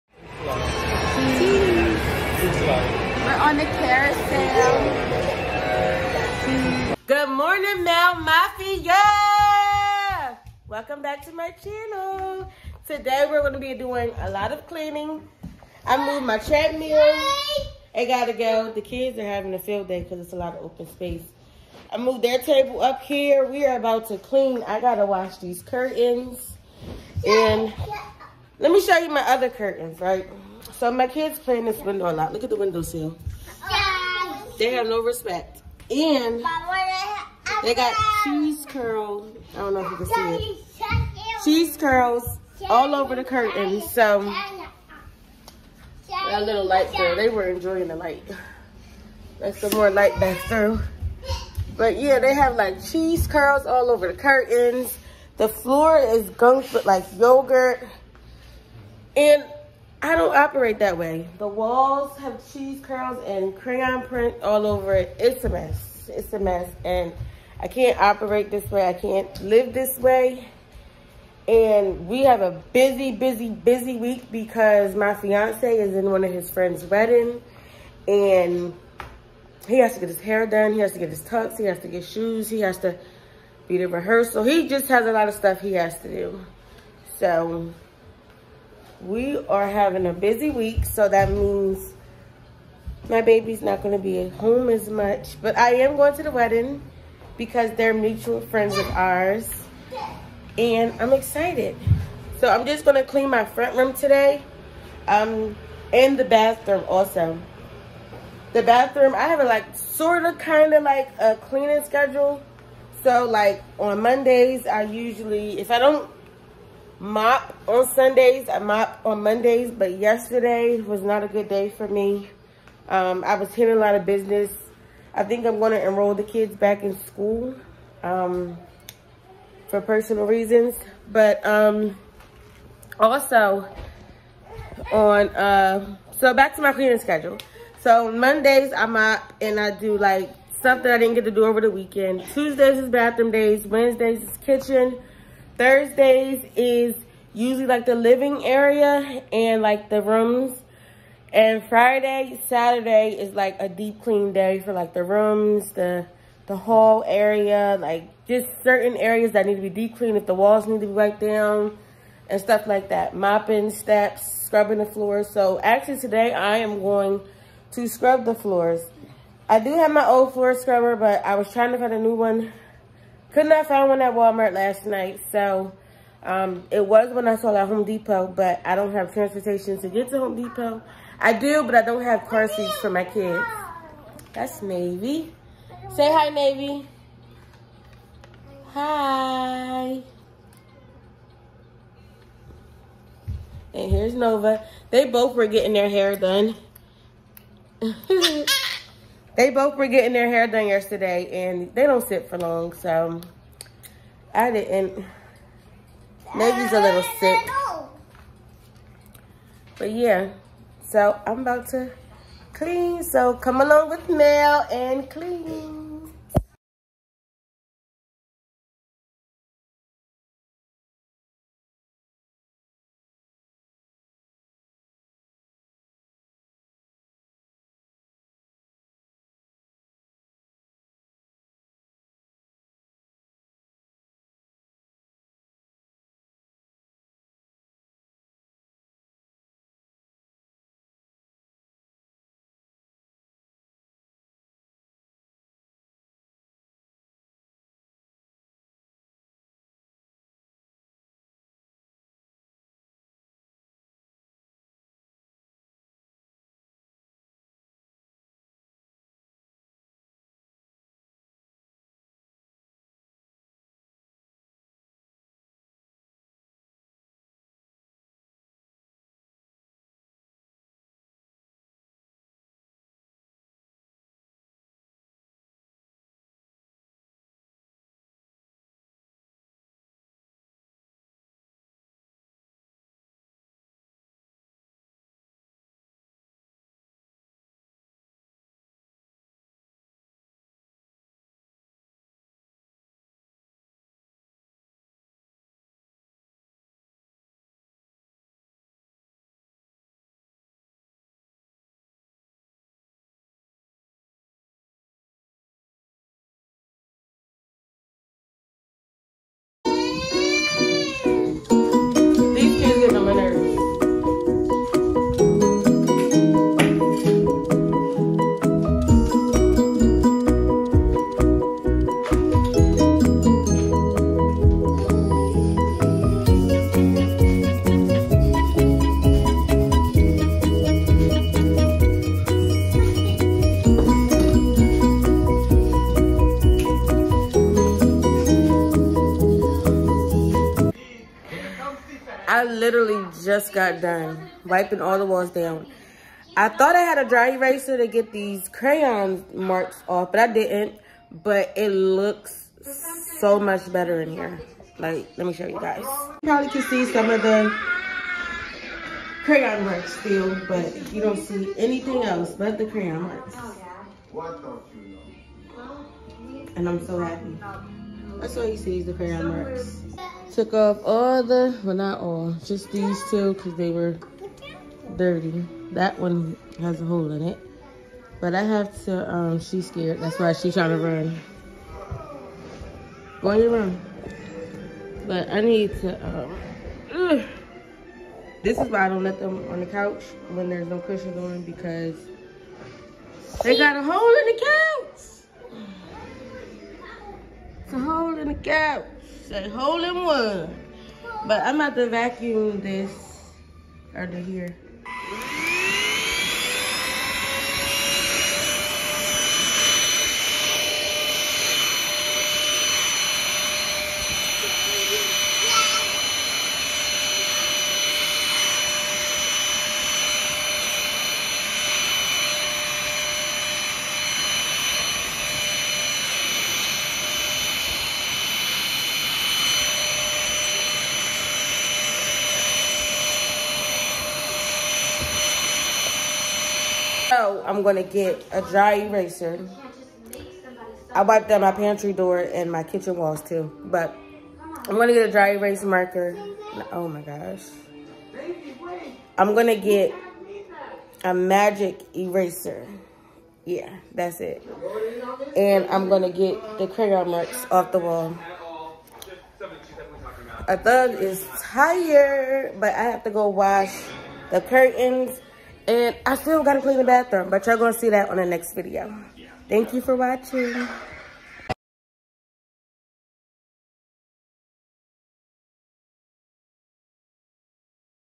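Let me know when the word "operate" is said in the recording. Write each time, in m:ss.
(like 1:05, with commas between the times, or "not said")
1:00, 1:07.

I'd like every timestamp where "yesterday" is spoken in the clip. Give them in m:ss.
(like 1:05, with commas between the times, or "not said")
1:59, 3:20.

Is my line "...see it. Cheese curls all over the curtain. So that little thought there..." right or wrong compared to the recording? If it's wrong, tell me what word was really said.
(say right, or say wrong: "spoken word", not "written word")
wrong: "light", not "thought".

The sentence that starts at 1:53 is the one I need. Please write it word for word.
So like on Mondays, I usually, if I don't mop on Sundays.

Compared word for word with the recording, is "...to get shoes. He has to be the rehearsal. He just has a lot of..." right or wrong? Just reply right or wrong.
right.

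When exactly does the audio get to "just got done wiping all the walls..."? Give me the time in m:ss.
5:43.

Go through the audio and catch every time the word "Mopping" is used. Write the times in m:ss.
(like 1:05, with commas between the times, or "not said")
2:43.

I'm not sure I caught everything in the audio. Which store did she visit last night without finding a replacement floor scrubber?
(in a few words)
Walmart.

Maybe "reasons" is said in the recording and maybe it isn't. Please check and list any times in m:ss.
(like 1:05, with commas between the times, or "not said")
2:10.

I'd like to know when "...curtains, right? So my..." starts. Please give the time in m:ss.
0:29.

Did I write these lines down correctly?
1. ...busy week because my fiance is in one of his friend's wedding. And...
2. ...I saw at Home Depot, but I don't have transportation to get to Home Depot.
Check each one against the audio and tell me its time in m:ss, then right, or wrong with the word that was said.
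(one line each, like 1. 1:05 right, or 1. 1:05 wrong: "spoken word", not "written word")
1. 1:13 right
2. 2:57 right.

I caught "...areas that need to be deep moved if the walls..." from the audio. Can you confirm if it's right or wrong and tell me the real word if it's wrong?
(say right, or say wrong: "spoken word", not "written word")
wrong: "cleaned", not "moved".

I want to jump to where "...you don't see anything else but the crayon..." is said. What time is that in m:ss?
6:00.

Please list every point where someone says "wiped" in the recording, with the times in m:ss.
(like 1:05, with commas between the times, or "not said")
2:40, 7:21.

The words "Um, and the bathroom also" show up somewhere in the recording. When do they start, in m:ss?
1:45.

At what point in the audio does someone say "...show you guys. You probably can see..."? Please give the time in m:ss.
5:55.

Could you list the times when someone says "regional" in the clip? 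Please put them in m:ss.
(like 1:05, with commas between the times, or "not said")
not said.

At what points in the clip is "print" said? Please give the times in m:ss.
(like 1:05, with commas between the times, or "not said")
1:04.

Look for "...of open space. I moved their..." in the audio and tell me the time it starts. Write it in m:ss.
0:20.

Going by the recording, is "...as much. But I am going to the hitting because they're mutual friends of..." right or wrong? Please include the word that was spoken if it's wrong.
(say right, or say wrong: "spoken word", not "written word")
wrong: "wedding", not "hitting".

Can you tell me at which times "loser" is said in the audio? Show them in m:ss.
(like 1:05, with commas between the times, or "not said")
not said.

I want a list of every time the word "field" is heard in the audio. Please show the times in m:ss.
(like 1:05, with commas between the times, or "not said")
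0:19.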